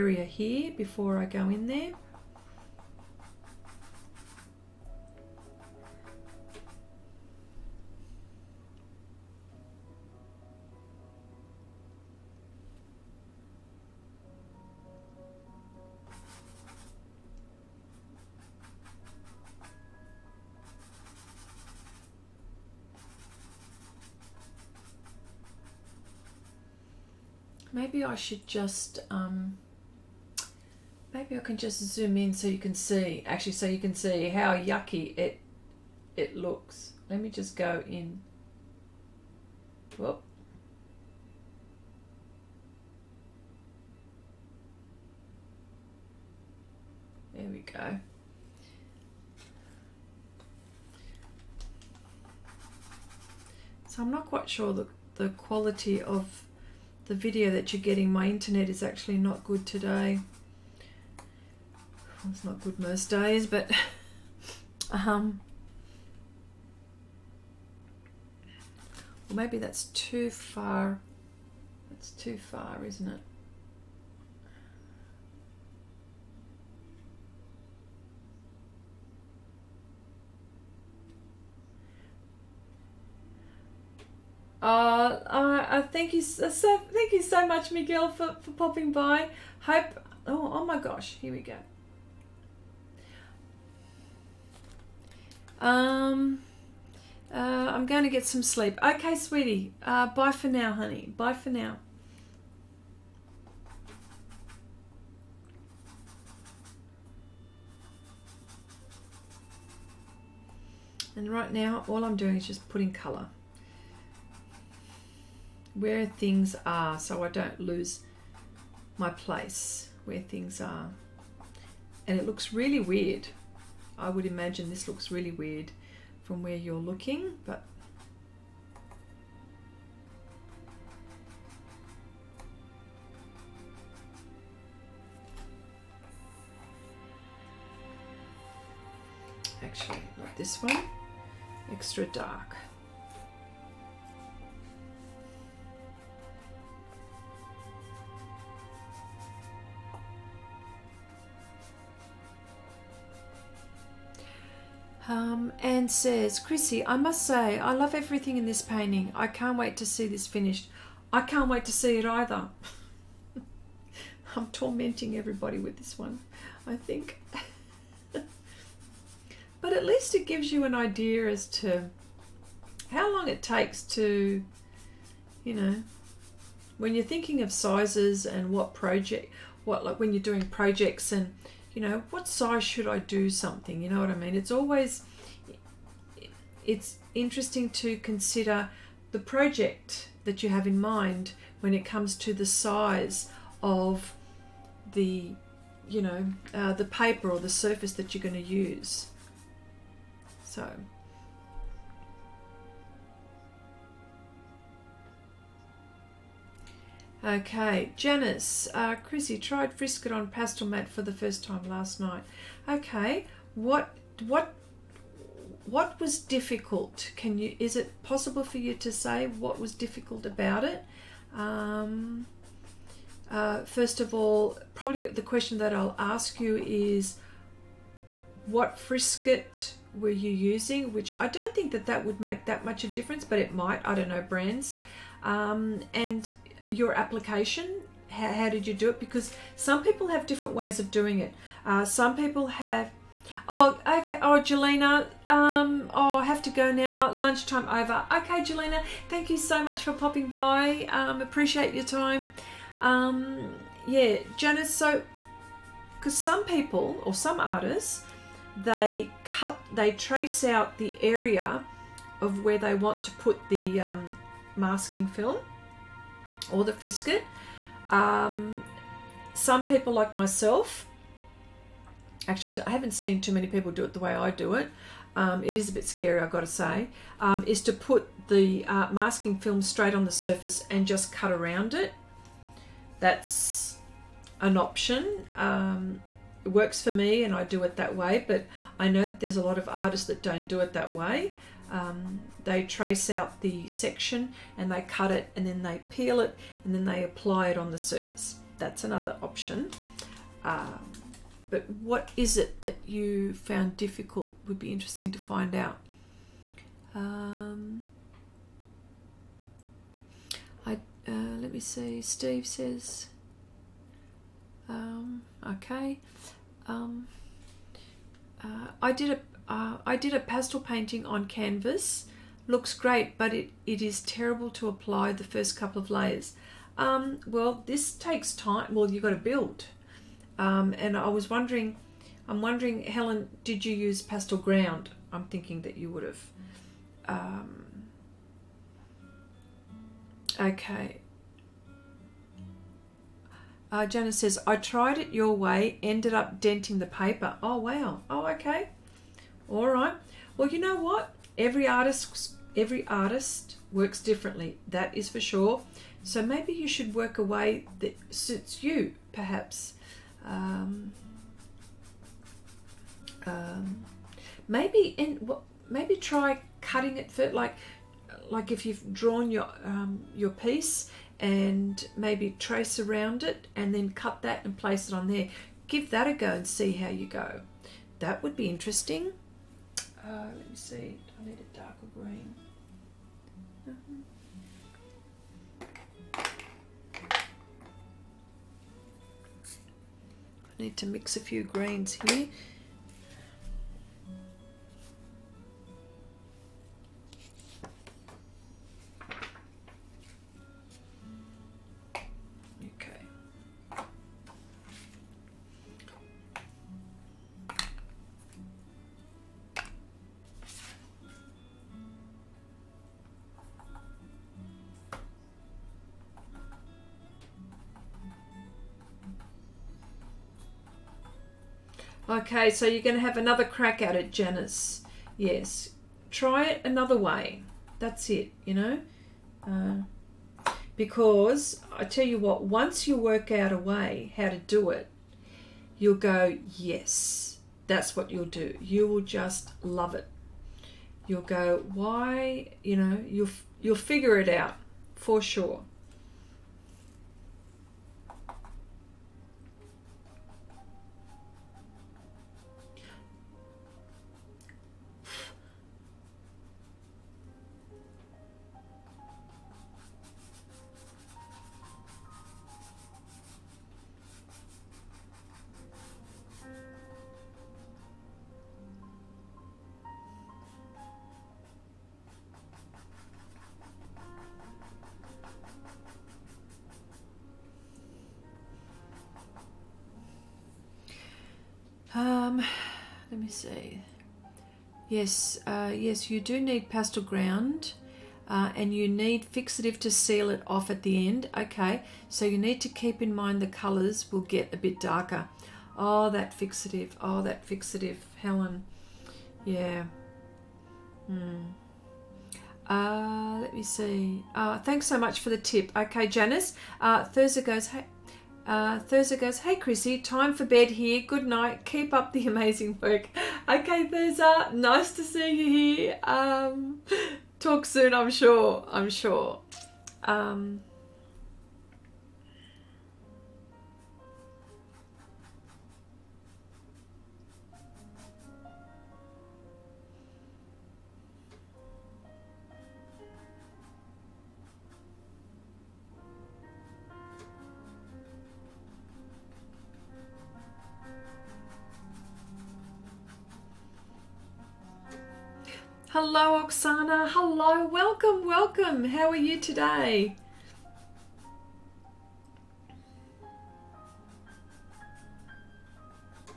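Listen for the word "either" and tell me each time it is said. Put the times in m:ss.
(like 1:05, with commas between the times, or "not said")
2:42.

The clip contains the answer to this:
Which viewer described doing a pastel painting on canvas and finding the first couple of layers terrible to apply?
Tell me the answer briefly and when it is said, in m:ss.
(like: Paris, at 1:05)
Steve, at 5:12.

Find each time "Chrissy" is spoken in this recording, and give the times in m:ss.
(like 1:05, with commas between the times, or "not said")
2:36, 3:28, 8:29.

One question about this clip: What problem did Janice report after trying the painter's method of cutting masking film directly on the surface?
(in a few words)
denting the paper.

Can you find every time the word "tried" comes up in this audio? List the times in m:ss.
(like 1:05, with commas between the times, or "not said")
3:29, 5:44.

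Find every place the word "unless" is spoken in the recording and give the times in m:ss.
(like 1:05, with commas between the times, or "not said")
not said.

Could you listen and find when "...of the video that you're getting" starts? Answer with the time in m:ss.
0:56.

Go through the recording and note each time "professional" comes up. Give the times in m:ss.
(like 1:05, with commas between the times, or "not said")
not said.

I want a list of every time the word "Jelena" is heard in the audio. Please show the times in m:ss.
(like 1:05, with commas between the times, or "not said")
4:04, 4:08.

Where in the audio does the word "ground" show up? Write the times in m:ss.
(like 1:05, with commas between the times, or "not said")
5:34, 8:07.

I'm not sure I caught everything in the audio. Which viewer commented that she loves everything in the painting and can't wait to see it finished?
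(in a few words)
Anne.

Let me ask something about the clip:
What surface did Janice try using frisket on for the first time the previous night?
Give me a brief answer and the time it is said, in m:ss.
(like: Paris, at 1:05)
Pastelmat, at 3:30.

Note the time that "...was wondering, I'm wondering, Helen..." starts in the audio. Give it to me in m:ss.
5:31.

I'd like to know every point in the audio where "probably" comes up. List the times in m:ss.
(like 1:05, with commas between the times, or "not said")
3:44.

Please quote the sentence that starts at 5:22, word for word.
Looks great, but it, it is terrible to apply the first couple of layers.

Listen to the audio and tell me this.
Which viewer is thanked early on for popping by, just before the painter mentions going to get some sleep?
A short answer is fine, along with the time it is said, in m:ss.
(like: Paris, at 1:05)
Miguel, at 1:27.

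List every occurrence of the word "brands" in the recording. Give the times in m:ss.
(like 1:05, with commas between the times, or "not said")
3:54.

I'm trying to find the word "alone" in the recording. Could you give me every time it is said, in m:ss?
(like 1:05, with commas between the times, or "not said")
not said.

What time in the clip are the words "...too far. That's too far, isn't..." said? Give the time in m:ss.
1:09.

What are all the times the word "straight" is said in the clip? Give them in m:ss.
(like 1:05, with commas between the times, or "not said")
4:39.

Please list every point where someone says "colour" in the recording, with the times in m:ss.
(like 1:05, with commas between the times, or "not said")
1:52, 8:13.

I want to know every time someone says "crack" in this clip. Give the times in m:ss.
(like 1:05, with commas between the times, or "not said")
7:03.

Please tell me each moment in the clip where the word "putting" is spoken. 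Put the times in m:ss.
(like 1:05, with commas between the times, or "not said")
1:52.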